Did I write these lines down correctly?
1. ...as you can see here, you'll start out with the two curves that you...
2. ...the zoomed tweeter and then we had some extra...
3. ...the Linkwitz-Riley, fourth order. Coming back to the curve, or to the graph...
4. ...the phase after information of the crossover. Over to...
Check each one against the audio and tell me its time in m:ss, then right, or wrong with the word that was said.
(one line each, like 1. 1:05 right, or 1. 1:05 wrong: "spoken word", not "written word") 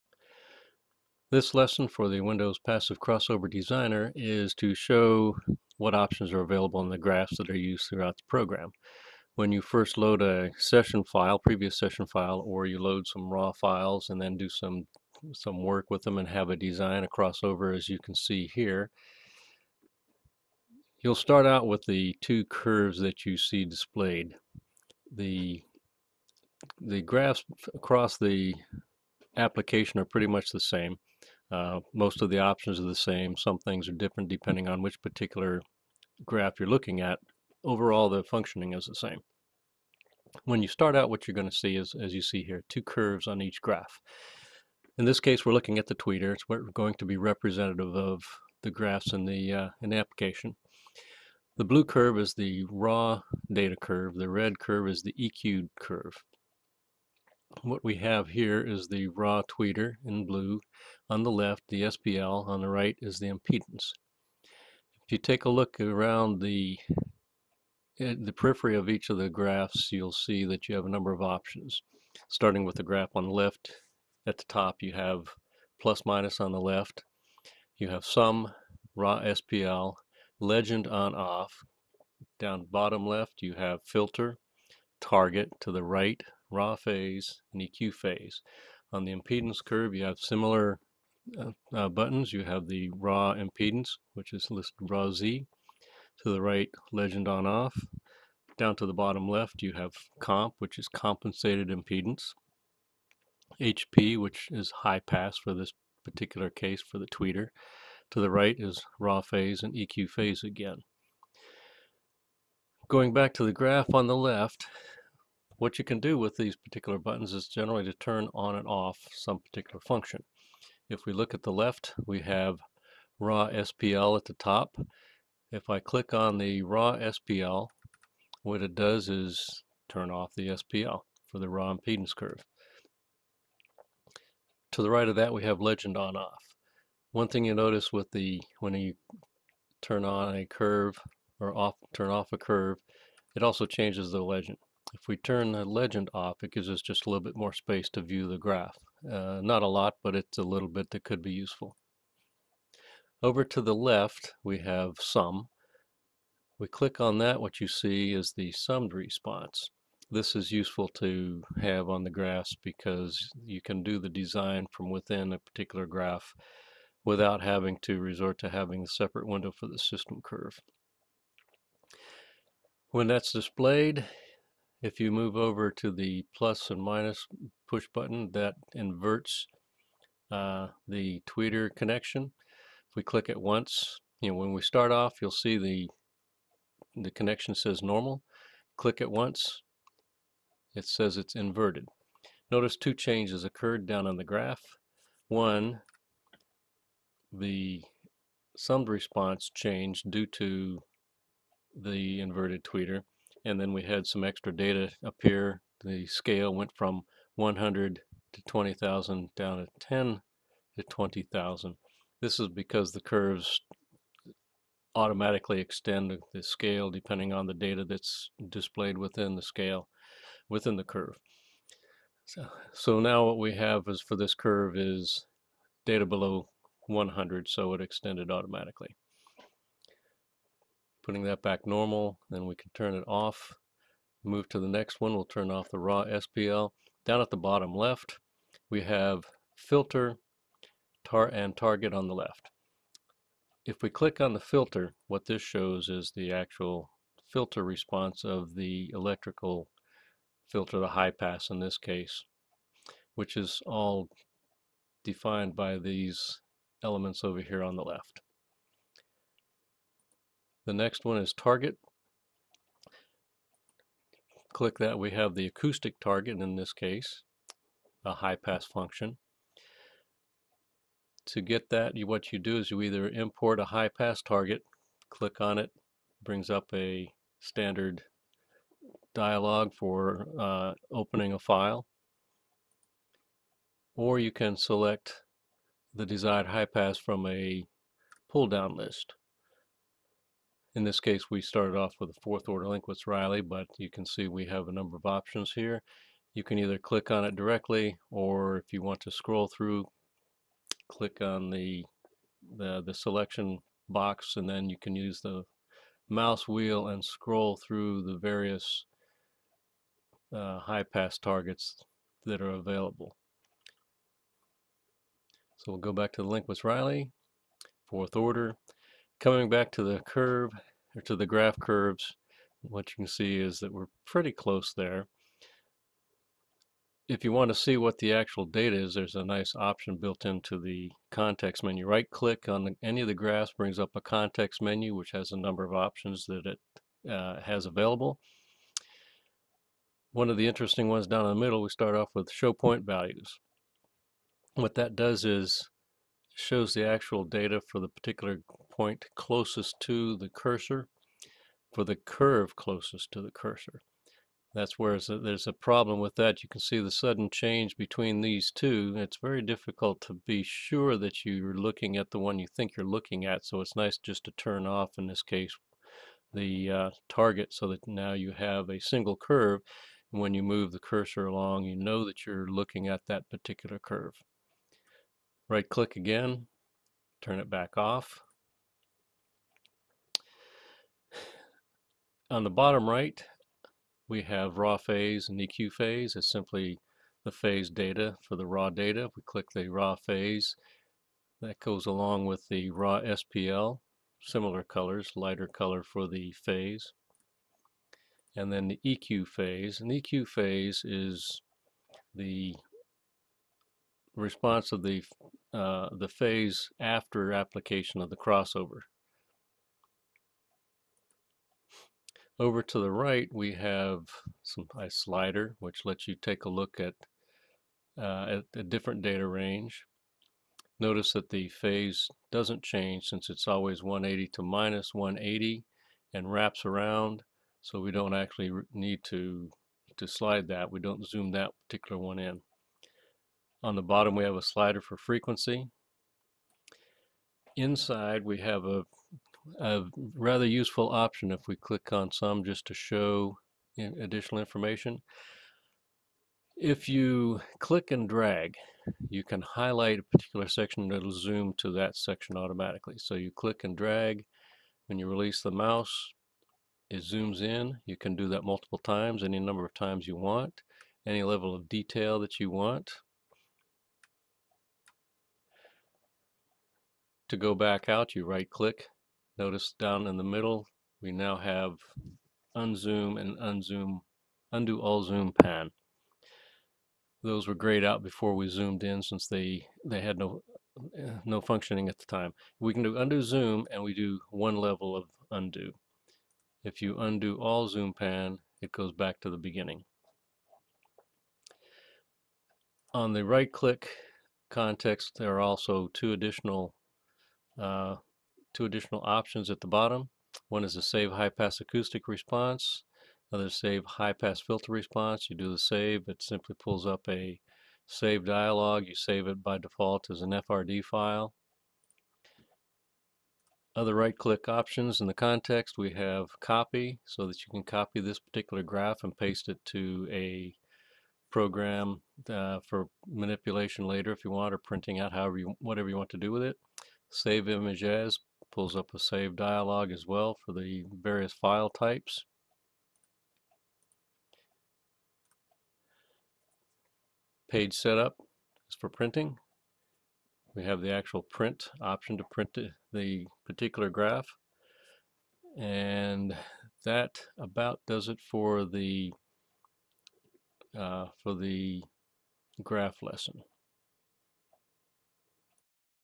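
1. 0:17 right
2. 3:21 wrong: "inverted", not "zoomed"
3. 5:16 right
4. 6:45 wrong: "application", not "information".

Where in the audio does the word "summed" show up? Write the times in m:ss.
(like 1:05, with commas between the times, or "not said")
2:38, 3:18.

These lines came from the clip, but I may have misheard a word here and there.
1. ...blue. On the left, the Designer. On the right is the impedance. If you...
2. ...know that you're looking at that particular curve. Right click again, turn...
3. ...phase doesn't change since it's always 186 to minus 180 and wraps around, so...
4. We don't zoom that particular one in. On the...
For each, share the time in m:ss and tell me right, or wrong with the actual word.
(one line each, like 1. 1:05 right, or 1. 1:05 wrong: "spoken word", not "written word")
1. 1:00 wrong: "SPL", not "Designer"
2. 6:11 right
3. 7:01 wrong: "180", not "186"
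4. 7:10 right.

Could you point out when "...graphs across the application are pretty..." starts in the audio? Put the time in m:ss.
0:27.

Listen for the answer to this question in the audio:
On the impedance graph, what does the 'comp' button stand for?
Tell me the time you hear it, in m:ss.
1:40.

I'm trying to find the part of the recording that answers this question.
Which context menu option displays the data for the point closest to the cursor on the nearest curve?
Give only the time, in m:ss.
5:42.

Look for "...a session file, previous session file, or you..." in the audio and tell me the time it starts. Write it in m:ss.
0:10.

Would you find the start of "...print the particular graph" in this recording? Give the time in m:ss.
9:02.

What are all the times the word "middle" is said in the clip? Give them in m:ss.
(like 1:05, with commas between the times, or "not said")
5:41, 7:50.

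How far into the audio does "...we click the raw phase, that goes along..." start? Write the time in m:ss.
6:29.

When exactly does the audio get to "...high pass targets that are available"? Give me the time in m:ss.
5:10.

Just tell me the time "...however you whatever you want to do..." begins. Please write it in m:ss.
8:45.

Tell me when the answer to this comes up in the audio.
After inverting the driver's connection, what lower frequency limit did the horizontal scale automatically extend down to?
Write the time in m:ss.
3:29.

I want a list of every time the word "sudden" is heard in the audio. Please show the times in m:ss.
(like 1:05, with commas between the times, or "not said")
5:56.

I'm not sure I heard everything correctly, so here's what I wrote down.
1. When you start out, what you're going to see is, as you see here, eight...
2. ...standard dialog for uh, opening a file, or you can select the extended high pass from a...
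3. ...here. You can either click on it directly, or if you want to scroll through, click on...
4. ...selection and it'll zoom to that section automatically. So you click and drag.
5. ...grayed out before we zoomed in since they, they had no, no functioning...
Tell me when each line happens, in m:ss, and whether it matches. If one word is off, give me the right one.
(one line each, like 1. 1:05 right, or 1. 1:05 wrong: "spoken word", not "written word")
1. 0:40 wrong: "two", not "eight"
2. 4:37 wrong: "desired", not "extended"
3. 4:55 right
4. 7:30 wrong: "section", not "selection"
5. 7:57 right.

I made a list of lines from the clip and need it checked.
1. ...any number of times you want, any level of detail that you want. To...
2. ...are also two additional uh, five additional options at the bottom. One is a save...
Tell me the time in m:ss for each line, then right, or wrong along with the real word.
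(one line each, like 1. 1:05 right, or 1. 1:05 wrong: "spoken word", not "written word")
1. 7:39 right
2. 8:15 wrong: "two", not "five".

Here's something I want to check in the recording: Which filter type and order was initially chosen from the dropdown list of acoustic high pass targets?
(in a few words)
Fourth order Linkwitz-Riley.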